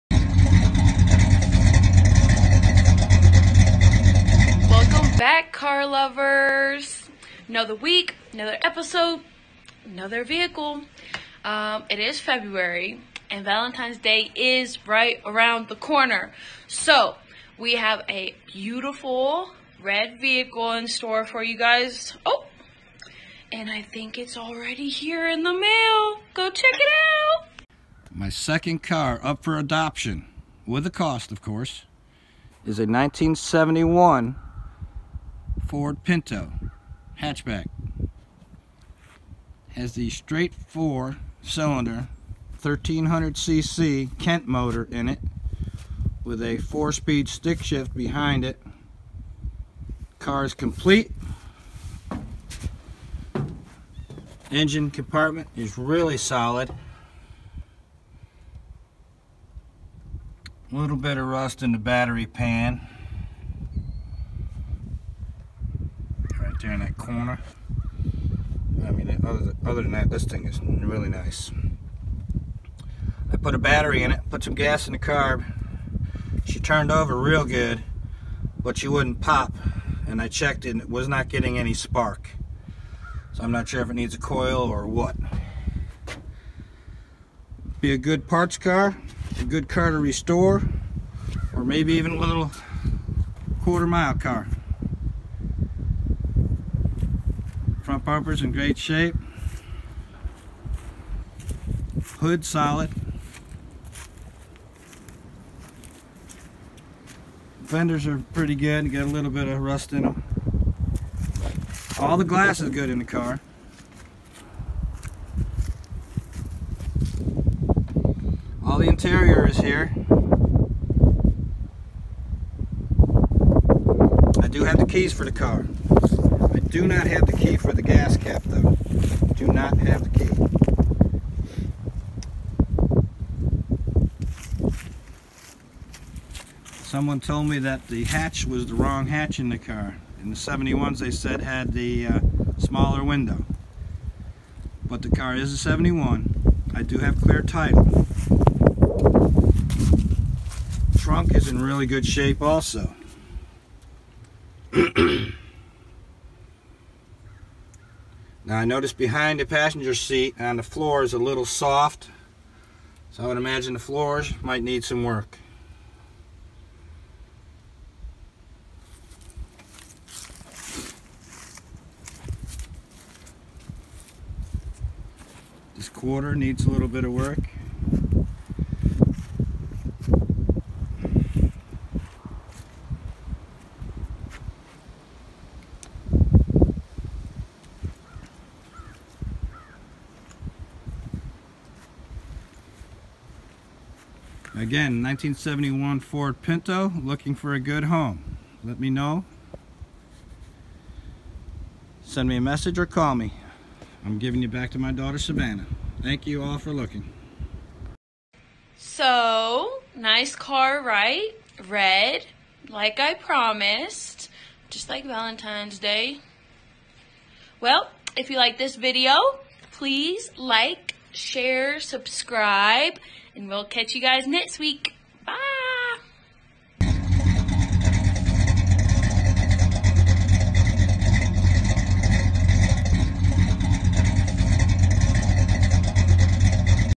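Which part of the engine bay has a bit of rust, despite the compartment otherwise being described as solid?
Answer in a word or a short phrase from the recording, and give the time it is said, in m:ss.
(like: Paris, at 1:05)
battery pan, at 1:01.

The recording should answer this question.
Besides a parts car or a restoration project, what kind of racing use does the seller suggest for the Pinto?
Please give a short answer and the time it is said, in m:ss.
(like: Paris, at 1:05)
quarter mile car, at 1:33.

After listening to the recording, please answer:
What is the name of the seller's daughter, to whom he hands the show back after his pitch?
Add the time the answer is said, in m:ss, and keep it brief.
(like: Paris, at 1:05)
Savannah, at 3:25.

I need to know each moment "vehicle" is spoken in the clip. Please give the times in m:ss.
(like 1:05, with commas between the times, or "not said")
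0:10, 0:20.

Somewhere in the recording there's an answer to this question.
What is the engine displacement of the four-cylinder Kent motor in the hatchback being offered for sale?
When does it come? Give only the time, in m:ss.
0:42.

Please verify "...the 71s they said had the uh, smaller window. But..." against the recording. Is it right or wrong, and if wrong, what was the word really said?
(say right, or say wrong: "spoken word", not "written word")
right.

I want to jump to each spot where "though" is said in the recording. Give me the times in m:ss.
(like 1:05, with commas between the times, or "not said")
2:08.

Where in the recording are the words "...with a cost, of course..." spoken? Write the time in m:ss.
0:30.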